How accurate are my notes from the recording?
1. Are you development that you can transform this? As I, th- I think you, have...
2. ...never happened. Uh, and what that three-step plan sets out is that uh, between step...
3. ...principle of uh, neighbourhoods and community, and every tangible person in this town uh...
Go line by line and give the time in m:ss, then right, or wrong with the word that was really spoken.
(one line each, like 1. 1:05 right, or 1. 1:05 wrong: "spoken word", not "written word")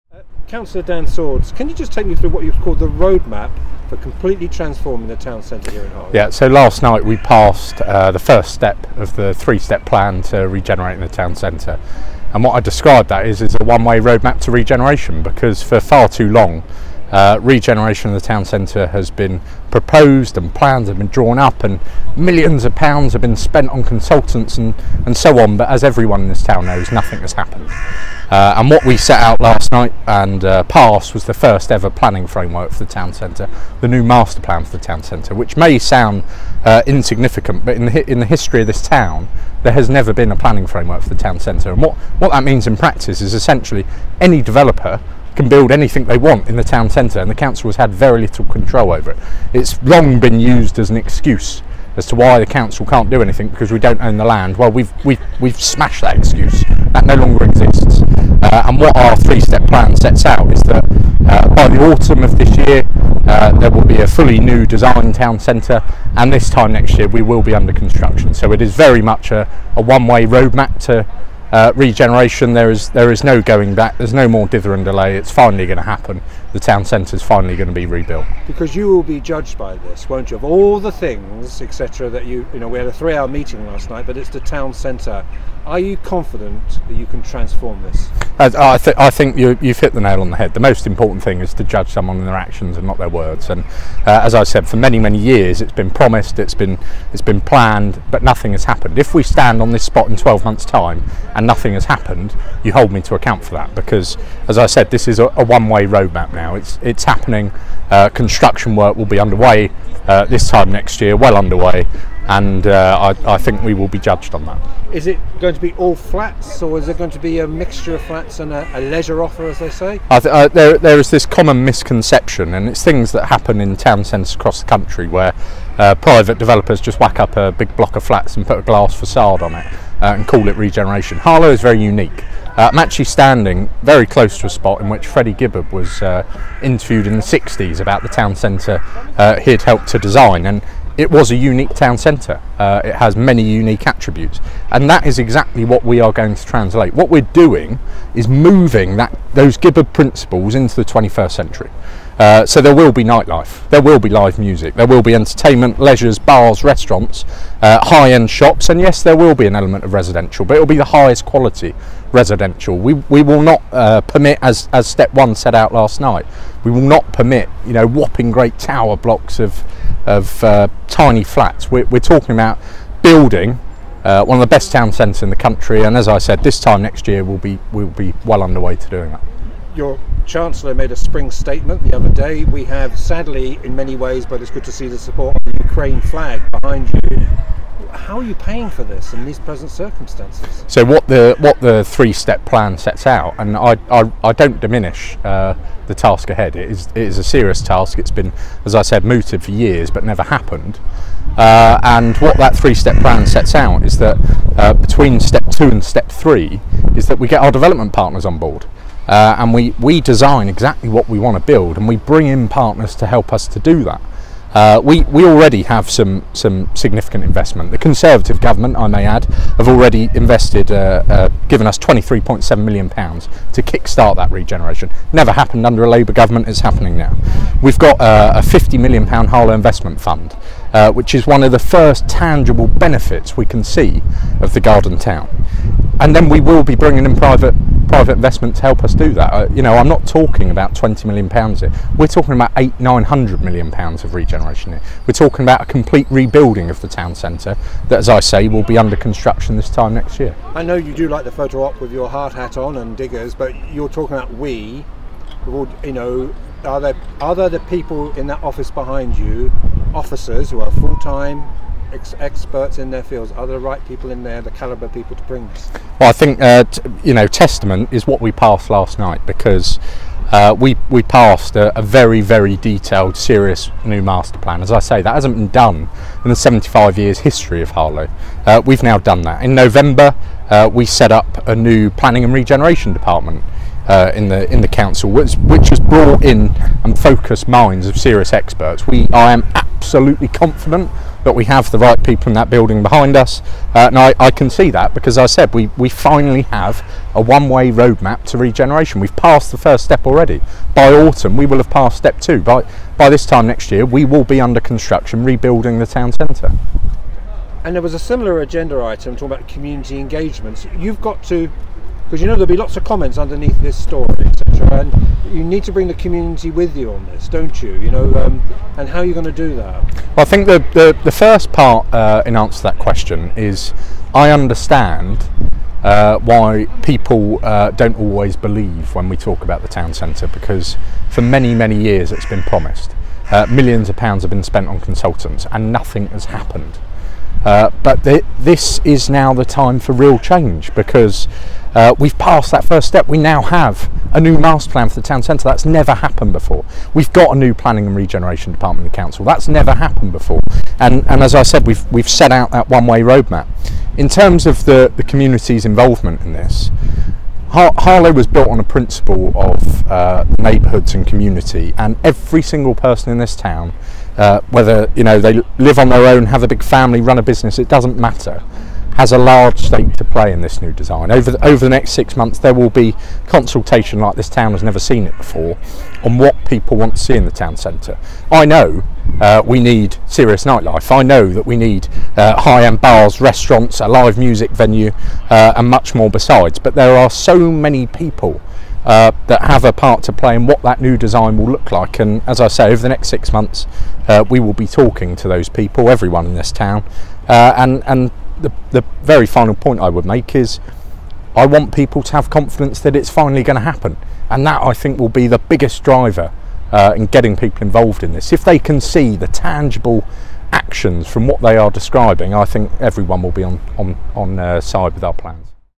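1. 1:25 wrong: "confident", not "development"
2. 3:20 right
3. 5:58 wrong: "single", not "tangible".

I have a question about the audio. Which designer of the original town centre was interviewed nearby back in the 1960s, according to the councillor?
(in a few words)
Freddie Gibberd.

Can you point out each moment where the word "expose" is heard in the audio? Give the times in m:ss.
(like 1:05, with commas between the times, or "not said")
not said.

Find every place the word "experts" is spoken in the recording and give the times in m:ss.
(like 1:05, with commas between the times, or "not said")
4:22, 4:48.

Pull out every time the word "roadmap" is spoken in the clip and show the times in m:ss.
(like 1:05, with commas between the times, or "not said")
0:02, 0:14, 1:10, 1:45, 4:57, 5:53.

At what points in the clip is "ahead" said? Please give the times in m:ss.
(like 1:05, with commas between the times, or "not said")
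3:16.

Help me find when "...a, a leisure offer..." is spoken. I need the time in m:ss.
1:58.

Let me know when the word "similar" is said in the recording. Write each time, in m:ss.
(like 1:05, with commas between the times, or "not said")
5:07.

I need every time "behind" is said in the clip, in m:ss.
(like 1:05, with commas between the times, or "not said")
3:06, 4:18, 4:52.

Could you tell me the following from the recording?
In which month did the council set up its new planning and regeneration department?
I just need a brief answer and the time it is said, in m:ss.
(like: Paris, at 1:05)
November, at 4:39.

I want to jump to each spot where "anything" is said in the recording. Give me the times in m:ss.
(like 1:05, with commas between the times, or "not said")
0:45, 0:53.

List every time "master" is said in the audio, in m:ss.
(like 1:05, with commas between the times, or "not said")
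0:34, 4:34, 5:44.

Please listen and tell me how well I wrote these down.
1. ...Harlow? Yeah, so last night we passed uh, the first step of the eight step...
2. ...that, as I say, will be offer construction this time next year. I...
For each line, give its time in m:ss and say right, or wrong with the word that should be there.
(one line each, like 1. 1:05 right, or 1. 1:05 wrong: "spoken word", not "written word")
1. 0:05 wrong: "three", not "eight"
2. 4:07 wrong: "under", not "offer".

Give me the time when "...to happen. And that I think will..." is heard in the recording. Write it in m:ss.
6:43.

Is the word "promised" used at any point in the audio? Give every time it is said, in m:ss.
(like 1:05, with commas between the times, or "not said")
1:35, 5:32.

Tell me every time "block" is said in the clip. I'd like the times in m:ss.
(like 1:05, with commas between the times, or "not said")
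2:07, 2:48.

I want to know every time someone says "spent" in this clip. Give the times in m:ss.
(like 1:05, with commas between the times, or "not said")
0:23, 5:34.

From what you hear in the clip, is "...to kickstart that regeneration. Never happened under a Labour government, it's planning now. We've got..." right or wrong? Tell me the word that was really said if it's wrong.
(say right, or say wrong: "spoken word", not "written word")
wrong: "happening", not "planning".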